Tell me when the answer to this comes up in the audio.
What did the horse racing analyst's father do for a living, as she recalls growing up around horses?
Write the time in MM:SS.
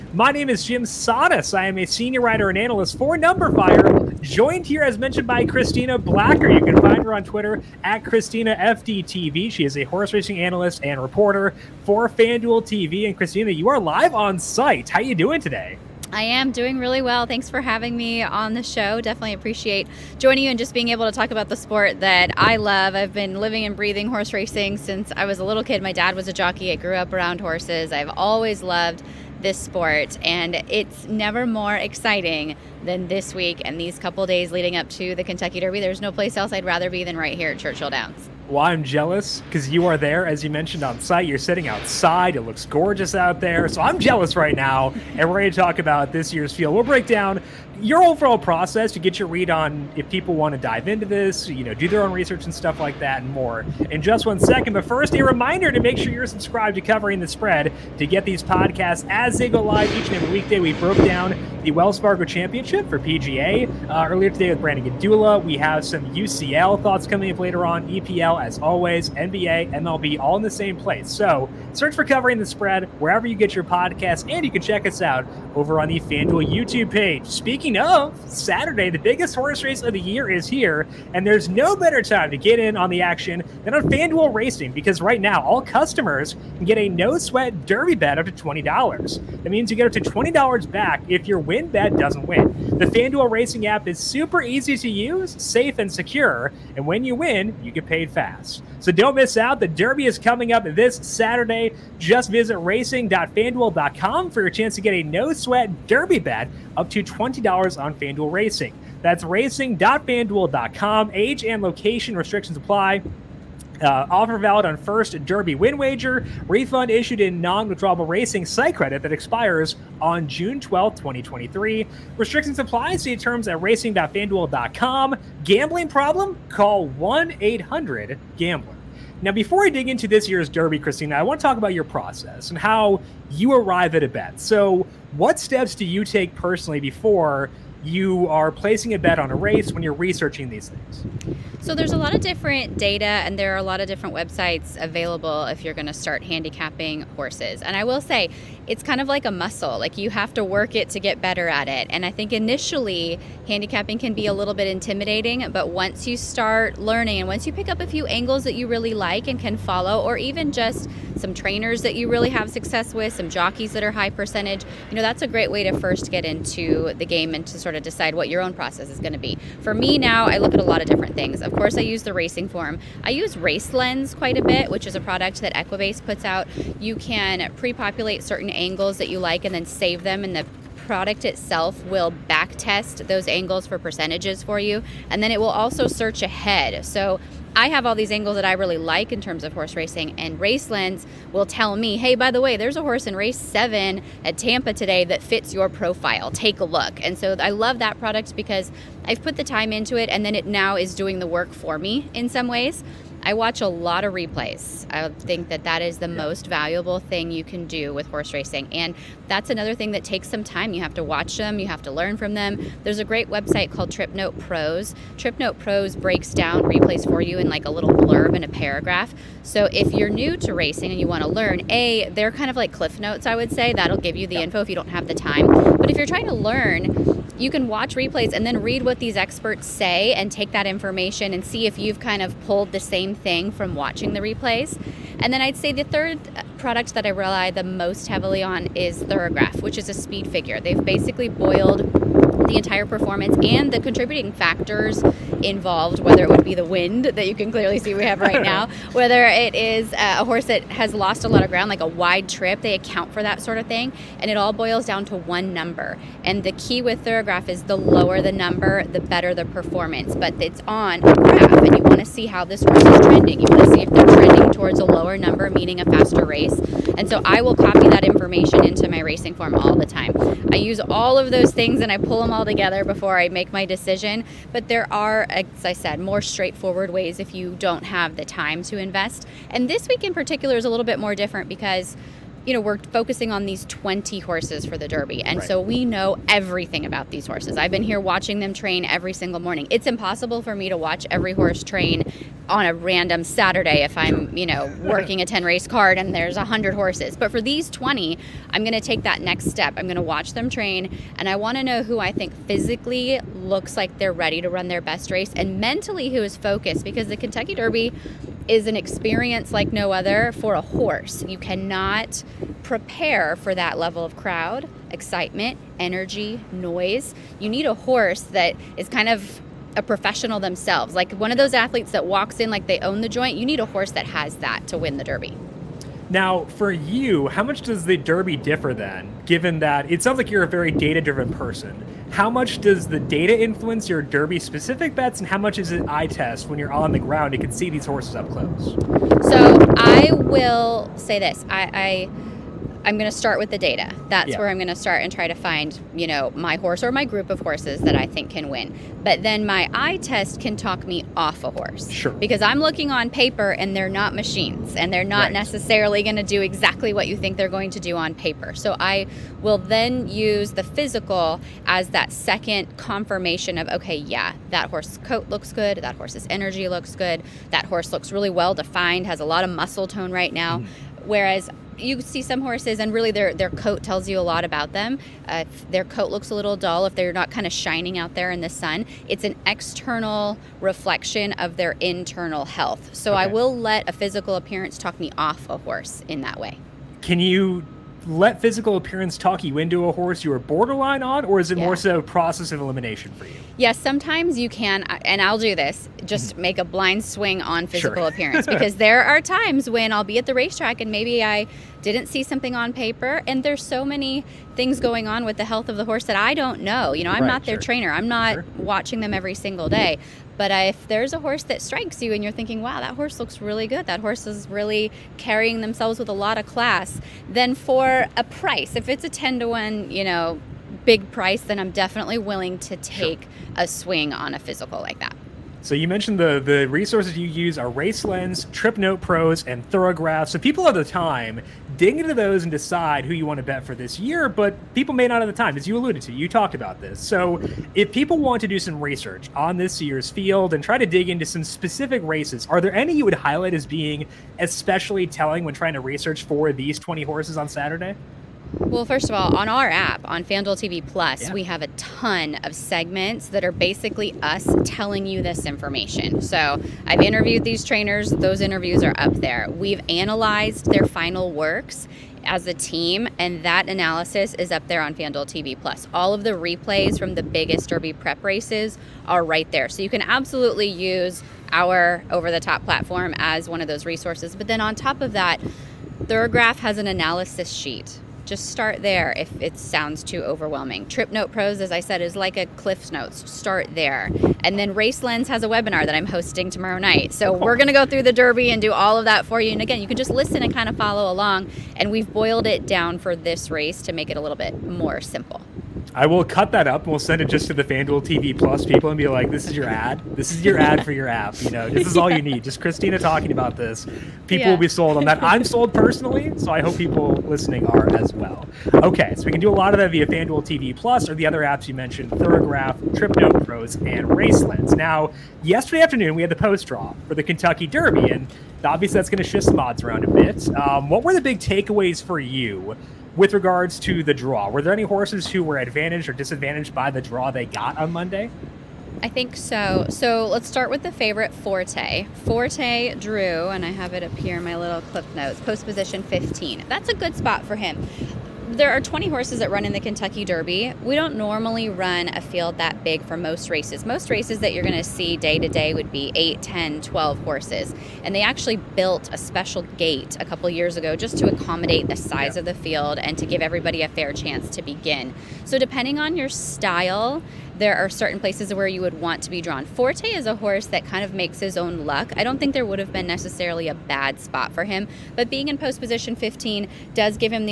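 00:26.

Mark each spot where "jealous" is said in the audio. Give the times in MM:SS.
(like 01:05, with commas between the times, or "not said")
00:38, 00:43.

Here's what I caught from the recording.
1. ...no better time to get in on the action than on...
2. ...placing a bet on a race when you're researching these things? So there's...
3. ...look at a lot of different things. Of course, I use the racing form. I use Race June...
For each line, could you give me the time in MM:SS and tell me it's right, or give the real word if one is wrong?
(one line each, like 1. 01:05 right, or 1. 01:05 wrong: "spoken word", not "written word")
1. 01:21 right
2. 02:18 right
3. 02:50 wrong: "Lens", not "June".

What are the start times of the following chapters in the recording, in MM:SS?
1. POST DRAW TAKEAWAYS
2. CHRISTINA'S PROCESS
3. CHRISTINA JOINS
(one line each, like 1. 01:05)
1. 08:37
2. 02:05
3. 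00:15.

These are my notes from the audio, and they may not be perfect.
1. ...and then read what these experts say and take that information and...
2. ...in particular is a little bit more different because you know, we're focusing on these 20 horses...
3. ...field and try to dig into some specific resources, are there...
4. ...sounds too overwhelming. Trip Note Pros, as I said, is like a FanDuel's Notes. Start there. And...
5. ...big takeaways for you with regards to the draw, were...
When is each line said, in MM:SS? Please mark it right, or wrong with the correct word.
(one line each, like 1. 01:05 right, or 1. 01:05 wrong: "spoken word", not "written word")
1. 03:48 right
2. 04:40 right
3. 07:20 wrong: "races", not "resources"
4. 07:59 wrong: "Cliff", not "FanDuel"
5. 08:41 right.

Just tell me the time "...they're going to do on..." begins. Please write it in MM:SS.
05:57.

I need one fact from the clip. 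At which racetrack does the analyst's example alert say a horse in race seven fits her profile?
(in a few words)
Tampa.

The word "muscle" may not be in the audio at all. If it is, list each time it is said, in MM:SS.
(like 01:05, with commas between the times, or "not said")
02:29, 06:09.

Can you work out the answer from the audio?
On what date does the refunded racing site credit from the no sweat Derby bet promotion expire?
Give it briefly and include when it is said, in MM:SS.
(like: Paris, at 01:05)
June 12, 2023, at 02:00.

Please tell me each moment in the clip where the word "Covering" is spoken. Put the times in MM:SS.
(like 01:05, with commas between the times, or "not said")
00:56, 01:12.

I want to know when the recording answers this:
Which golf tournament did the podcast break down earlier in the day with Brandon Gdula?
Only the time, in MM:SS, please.
01:01.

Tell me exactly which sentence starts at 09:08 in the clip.
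And they actually built a special gate a couple years ago just to accommodate the size yeah.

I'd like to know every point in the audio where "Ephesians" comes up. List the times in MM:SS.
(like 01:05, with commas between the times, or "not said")
not said.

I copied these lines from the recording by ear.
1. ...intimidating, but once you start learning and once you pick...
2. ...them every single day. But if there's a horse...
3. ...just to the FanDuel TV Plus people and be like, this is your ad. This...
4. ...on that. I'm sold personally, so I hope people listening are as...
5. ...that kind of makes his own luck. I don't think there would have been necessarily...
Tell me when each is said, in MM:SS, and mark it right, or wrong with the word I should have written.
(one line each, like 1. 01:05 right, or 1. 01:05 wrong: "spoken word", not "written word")
1. 02:34 right
2. 06:49 right
3. 08:17 right
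4. 08:24 right
5. 09:20 right.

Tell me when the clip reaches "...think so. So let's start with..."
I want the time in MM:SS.
08:49.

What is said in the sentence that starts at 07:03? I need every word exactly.
a swing on a physical like that.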